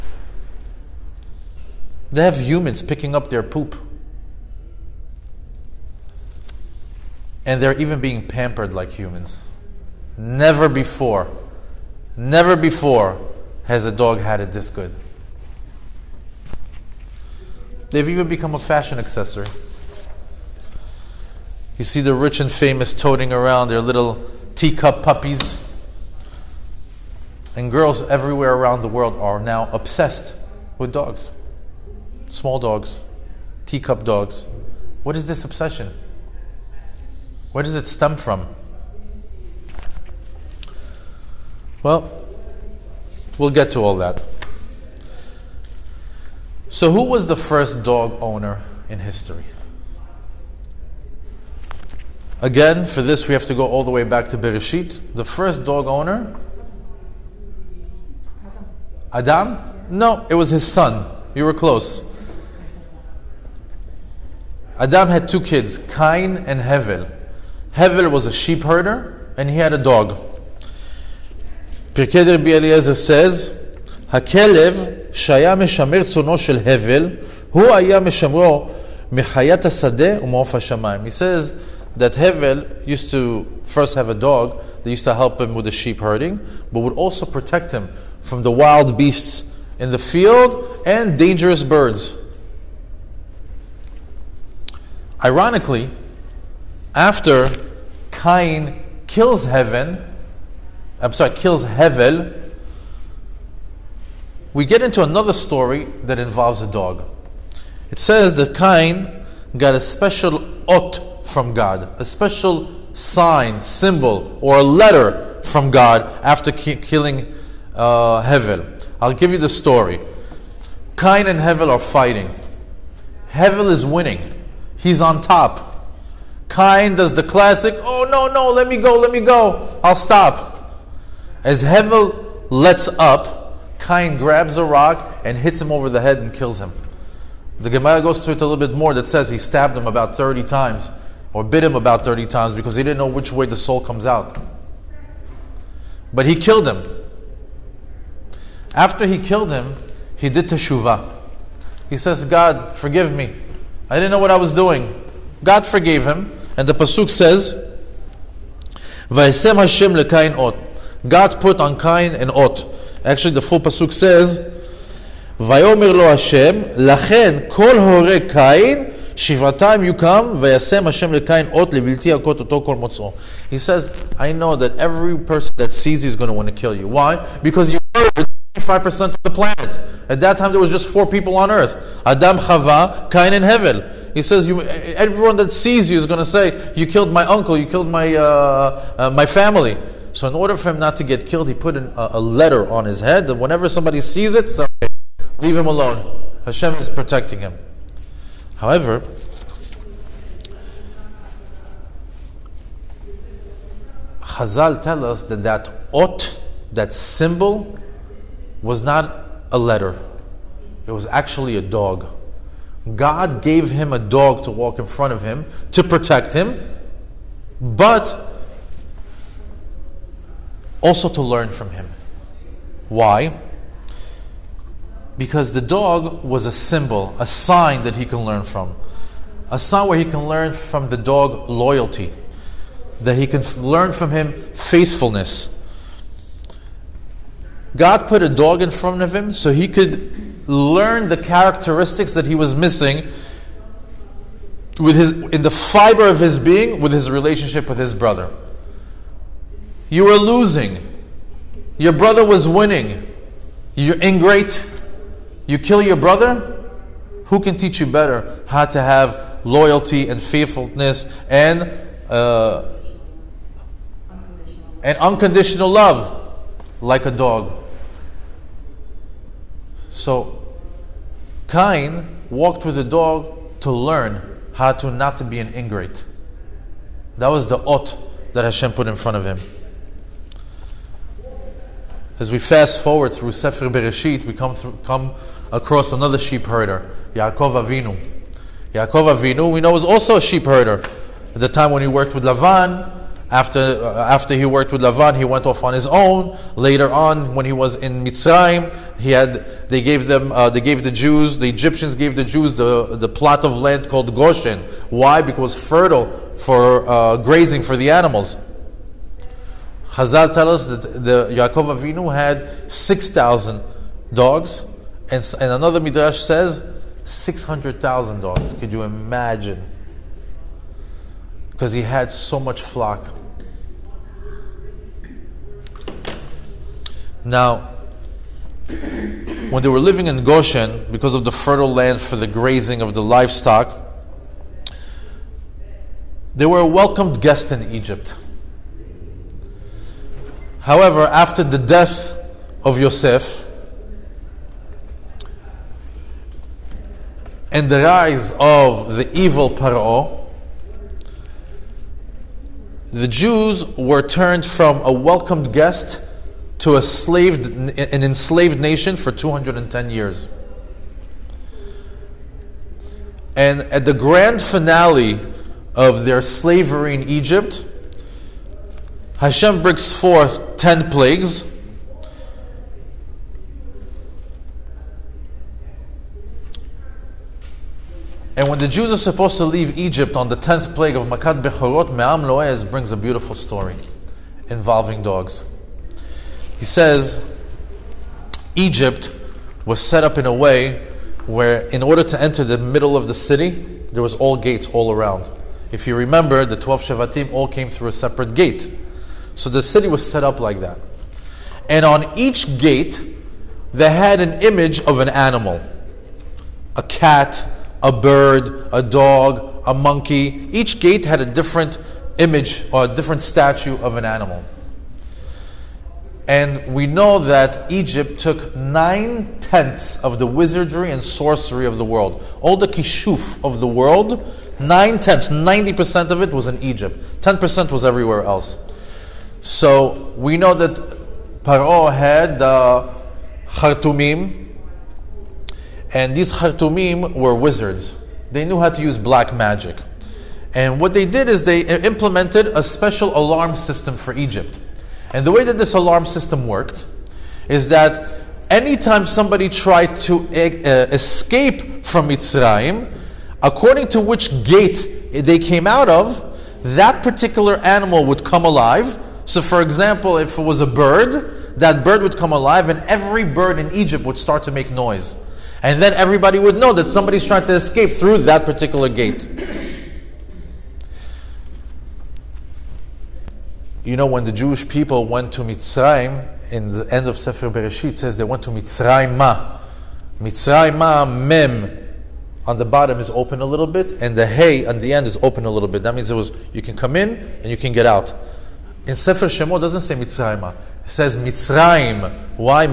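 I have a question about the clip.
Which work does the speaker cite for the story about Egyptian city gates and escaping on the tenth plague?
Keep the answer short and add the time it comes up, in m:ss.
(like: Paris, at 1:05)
Me'am Loez, at 6:21.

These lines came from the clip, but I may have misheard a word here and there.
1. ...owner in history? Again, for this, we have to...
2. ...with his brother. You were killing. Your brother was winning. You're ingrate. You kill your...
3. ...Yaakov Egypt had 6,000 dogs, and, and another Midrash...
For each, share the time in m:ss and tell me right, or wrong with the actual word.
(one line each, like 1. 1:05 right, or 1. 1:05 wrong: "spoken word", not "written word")
1. 0:48 right
2. 4:07 wrong: "losing", not "killing"
3. 5:11 wrong: "Avinu", not "Egypt".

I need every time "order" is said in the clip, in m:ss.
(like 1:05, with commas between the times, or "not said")
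3:10, 6:31.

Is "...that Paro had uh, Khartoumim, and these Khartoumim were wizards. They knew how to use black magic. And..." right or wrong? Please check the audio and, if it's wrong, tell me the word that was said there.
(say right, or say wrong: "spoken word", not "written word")
right.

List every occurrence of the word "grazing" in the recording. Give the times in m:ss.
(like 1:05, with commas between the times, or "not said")
5:07, 5:32.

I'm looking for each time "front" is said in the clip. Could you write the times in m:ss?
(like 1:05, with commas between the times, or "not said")
3:34, 3:58, 4:38.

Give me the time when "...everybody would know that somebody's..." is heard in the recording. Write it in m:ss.
7:45.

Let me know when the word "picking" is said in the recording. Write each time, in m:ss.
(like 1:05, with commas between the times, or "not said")
0:02.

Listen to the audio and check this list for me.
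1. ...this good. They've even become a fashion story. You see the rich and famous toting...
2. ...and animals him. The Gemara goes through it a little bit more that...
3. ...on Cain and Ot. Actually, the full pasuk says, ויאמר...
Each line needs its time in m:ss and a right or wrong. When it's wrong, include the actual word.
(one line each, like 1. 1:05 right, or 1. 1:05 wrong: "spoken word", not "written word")
1. 0:14 wrong: "accessory", not "story"
2. 2:16 wrong: "kills", not "animals"
3. 2:41 right.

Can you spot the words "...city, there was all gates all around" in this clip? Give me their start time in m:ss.
6:33.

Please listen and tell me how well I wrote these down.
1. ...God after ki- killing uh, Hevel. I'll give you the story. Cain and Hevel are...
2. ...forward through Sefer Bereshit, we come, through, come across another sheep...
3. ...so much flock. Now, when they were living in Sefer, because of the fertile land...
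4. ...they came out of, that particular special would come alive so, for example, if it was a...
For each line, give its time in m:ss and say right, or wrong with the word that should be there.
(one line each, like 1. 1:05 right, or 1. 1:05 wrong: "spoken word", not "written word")
1. 1:55 right
2. 4:42 right
3. 5:22 wrong: "Goshen", not "Sefer"
4. 7:35 wrong: "animal", not "special".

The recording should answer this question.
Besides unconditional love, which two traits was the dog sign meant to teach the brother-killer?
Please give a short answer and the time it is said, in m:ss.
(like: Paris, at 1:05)
Loyalty and faithfulness, at 3:51.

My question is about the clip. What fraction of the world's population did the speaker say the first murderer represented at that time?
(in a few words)
25%.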